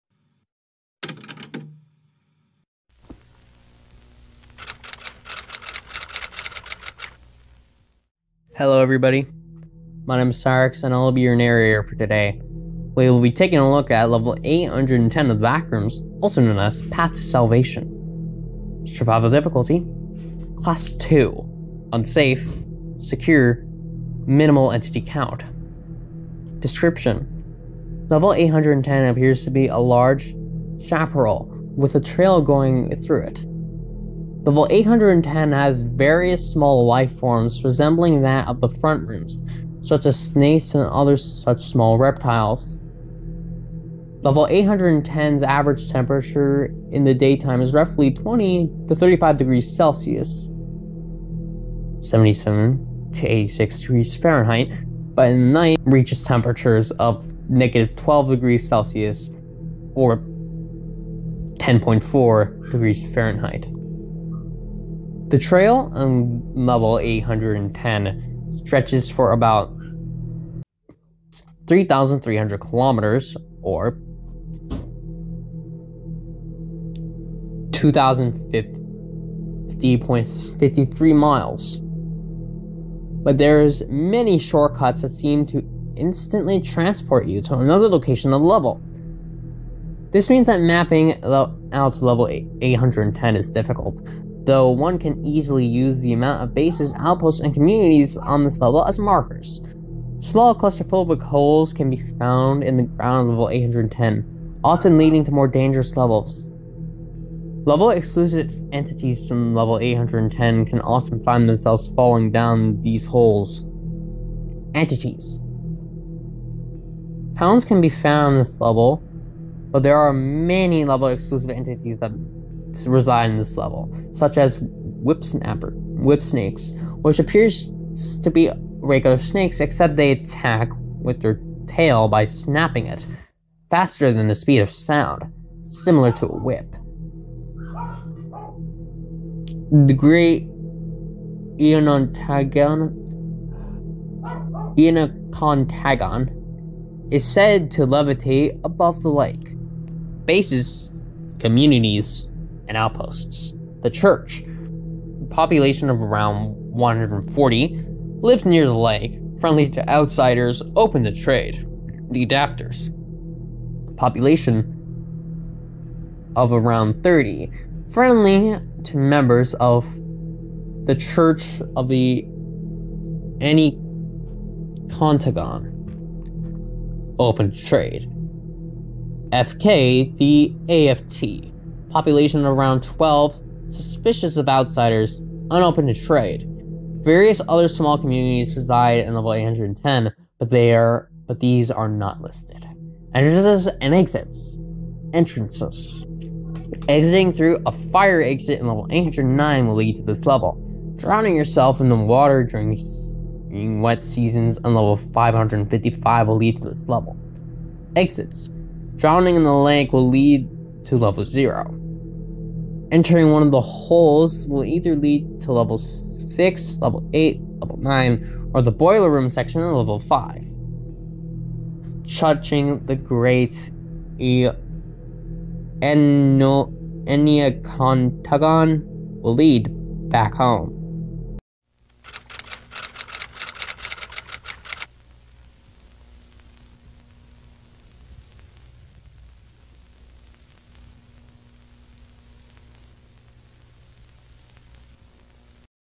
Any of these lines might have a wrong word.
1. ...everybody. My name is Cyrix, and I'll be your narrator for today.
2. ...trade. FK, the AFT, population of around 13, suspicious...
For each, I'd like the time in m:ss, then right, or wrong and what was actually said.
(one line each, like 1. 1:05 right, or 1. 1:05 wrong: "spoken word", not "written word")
1. 0:08 right
2. 2:57 wrong: "12", not "13".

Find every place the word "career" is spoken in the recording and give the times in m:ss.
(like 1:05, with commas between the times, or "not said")
not said.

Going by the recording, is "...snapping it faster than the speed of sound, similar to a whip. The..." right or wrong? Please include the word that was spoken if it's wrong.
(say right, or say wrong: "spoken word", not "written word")
right.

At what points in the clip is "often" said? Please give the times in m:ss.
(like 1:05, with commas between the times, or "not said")
1:44, 1:50.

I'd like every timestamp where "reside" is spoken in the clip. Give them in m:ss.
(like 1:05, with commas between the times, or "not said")
2:02, 3:08.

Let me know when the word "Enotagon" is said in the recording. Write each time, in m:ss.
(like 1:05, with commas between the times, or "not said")
2:21.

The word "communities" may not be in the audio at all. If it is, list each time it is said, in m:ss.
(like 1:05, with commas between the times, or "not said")
1:37, 2:31, 3:07.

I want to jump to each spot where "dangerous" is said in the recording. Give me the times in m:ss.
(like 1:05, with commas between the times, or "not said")
1:45.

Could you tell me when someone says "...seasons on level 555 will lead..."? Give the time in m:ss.
3:24.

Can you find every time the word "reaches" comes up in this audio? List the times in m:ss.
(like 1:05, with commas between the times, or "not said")
0:55.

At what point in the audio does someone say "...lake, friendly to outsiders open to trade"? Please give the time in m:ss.
2:38.